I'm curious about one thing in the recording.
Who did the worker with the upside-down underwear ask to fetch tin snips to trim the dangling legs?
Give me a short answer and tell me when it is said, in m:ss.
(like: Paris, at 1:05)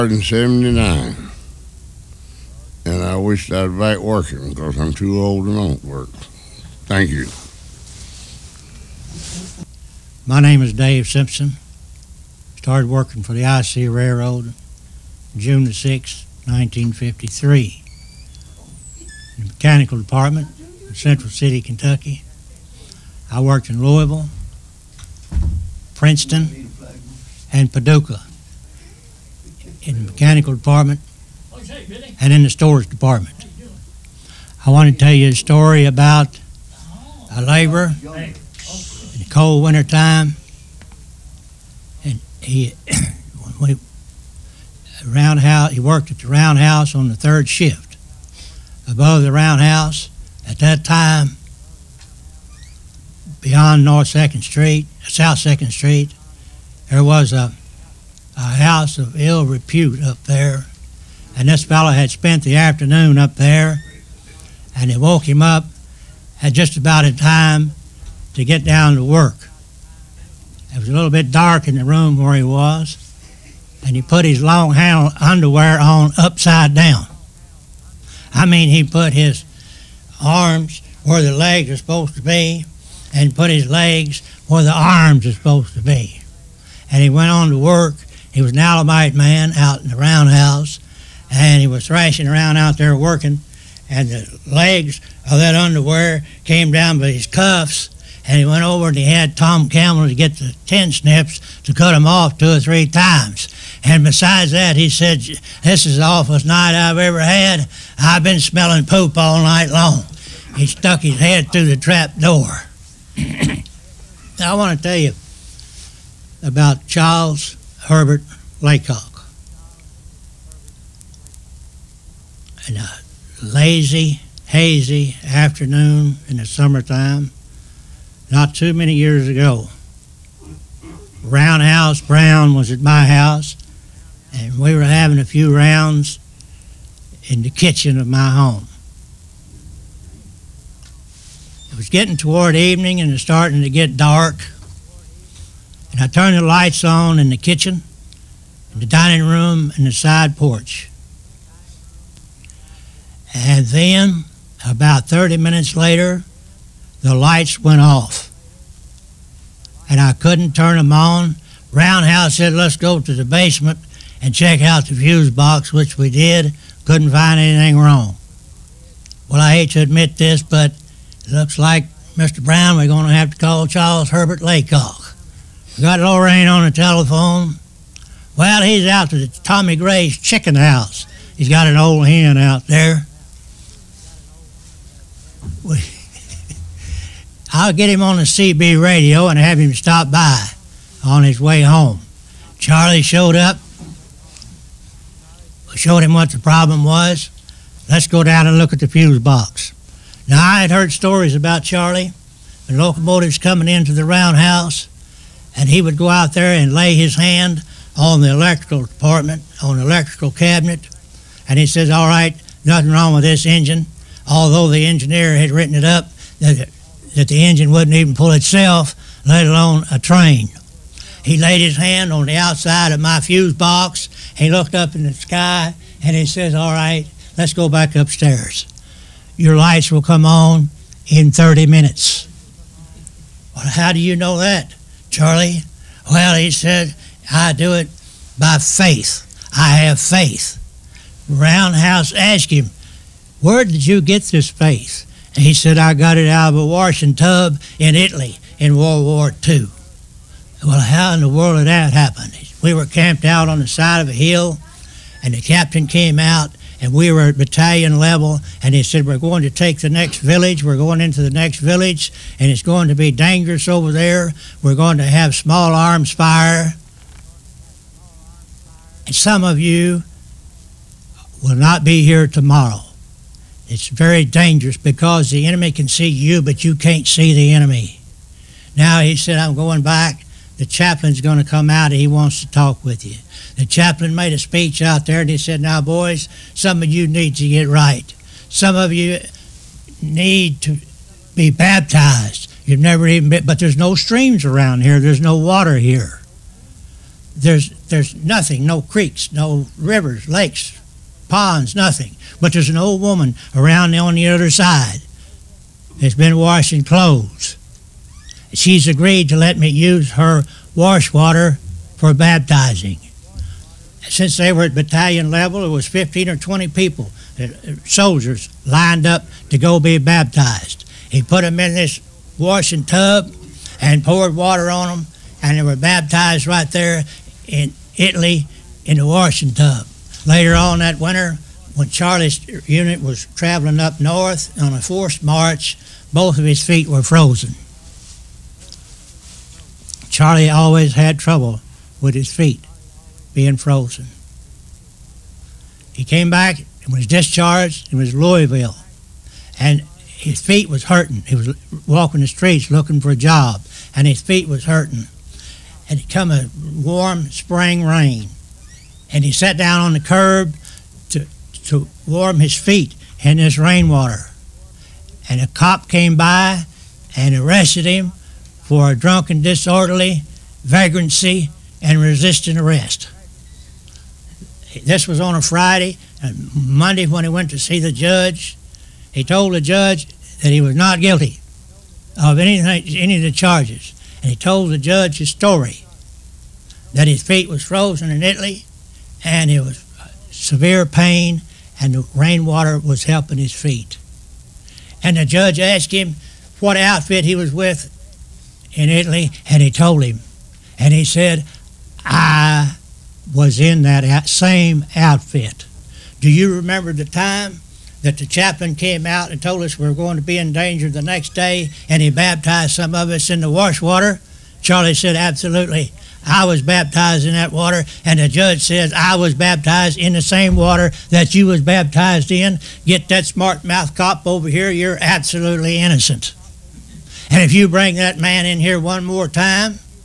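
Tom Campbell, at 1:39.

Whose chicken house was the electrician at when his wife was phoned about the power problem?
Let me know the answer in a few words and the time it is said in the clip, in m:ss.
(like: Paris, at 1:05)
Tommy Gray's, at 2:59.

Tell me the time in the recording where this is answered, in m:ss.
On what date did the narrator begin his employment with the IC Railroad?
0:15.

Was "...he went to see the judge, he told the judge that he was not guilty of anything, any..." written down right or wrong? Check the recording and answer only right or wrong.
right.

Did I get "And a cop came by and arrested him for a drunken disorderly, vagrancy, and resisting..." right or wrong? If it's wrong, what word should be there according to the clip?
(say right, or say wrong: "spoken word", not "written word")
right.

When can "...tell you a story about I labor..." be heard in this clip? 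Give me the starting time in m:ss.
0:34.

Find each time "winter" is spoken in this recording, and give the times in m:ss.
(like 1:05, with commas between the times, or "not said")
0:39, 5:30.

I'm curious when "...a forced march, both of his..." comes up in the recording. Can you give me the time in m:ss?
5:34.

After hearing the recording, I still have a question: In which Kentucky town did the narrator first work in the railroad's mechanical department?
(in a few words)
Central City.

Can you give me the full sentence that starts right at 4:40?
The chaplain's going to come out and he wants to talk with you.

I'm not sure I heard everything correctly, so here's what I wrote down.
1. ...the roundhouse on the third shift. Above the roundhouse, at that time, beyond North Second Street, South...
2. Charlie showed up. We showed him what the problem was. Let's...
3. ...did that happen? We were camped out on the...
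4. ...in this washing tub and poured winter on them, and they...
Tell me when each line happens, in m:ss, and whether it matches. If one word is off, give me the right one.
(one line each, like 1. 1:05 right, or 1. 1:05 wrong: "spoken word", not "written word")
1. 0:46 right
2. 3:12 right
3. 4:11 right
4. 5:21 wrong: "water", not "winter".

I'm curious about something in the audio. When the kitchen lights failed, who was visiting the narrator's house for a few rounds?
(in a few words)
Roundhouse Brown.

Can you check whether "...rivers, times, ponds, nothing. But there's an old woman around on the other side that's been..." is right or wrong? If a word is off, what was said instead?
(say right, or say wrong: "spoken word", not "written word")
wrong: "lakes", not "times".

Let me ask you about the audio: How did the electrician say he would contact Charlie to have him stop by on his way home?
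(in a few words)
CB radio.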